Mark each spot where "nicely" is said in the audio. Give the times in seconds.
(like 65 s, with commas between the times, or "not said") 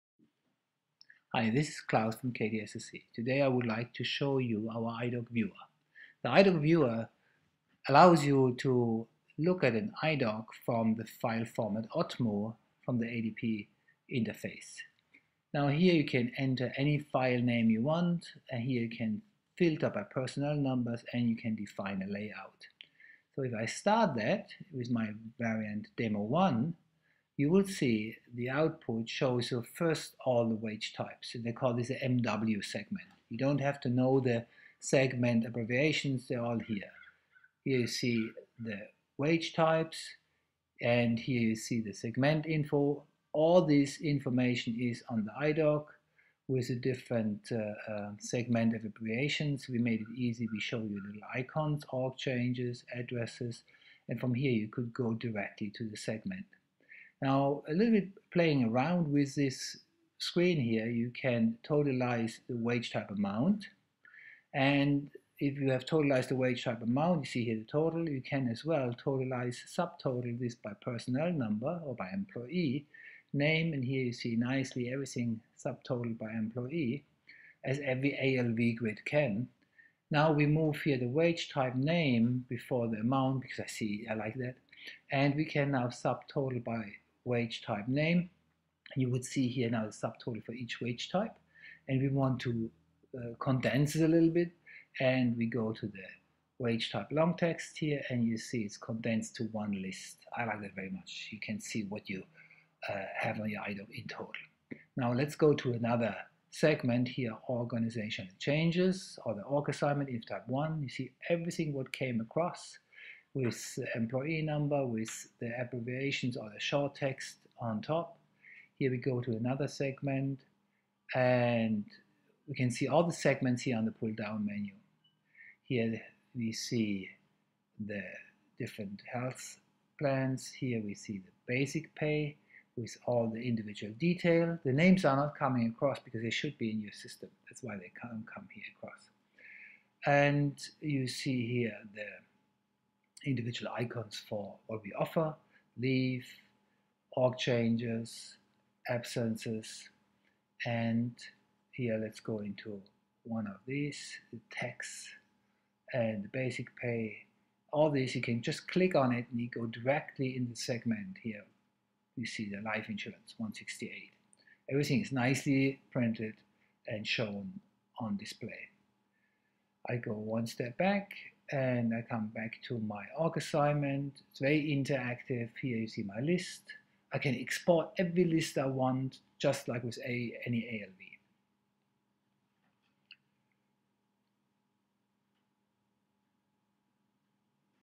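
74 s, 165 s.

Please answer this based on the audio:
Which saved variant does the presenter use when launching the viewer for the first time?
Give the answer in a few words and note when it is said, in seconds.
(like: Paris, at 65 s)
demo1, at 25 s.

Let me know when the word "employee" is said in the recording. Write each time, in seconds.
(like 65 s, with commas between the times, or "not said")
72 s, 76 s, 113 s.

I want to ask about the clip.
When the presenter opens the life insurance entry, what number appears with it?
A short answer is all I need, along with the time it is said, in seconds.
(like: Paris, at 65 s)
168, at 163 s.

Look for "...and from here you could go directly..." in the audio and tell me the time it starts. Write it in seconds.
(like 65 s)
54 s.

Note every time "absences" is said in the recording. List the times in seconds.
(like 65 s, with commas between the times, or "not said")
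148 s.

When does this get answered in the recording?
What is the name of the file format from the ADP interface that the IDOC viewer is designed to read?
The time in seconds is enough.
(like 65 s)
11 s.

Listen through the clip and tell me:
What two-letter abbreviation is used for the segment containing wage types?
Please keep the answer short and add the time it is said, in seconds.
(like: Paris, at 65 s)
MW, at 31 s.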